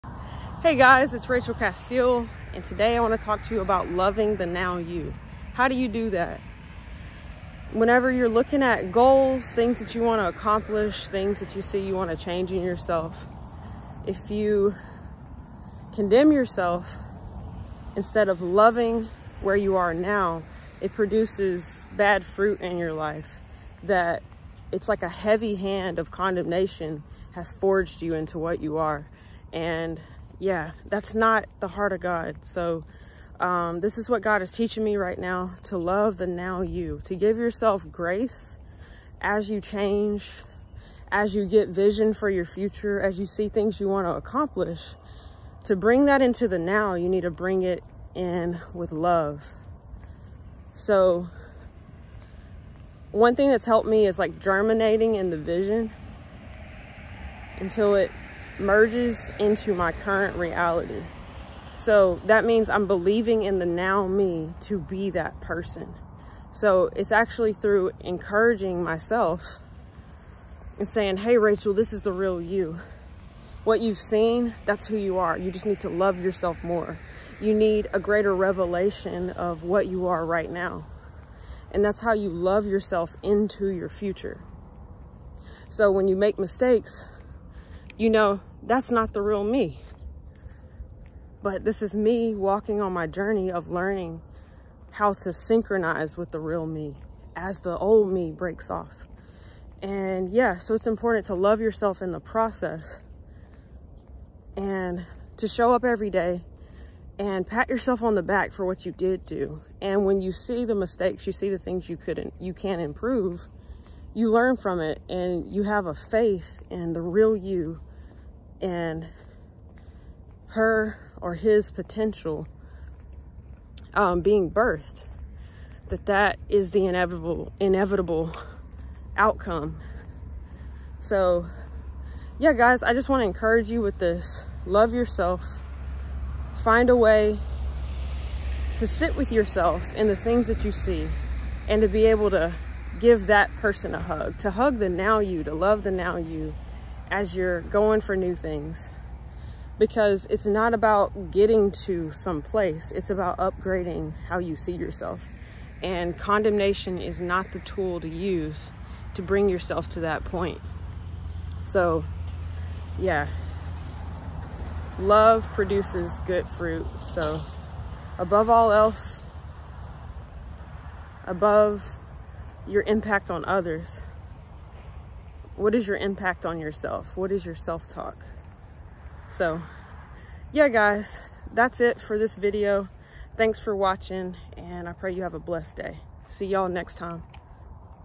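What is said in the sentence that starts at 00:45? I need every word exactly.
To bring that into the now, you need to bring it in with love.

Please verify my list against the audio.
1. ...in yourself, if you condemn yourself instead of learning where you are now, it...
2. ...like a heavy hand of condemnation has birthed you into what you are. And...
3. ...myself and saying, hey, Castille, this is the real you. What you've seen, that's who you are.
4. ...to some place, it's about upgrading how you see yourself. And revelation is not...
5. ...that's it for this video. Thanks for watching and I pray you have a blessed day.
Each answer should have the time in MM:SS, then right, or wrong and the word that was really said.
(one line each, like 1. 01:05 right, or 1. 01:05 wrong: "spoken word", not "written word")
1. 00:12 wrong: "loving", not "learning"
2. 00:24 wrong: "forged", not "birthed"
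3. 01:08 wrong: "Rachel", not "Castille"
4. 02:31 wrong: "condemnation", not "revelation"
5. 03:01 right.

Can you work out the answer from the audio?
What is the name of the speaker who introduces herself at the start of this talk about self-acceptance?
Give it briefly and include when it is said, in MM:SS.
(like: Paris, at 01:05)
Rachel Castille, at 00:01.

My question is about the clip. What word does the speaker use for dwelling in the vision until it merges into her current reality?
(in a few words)
Germinating.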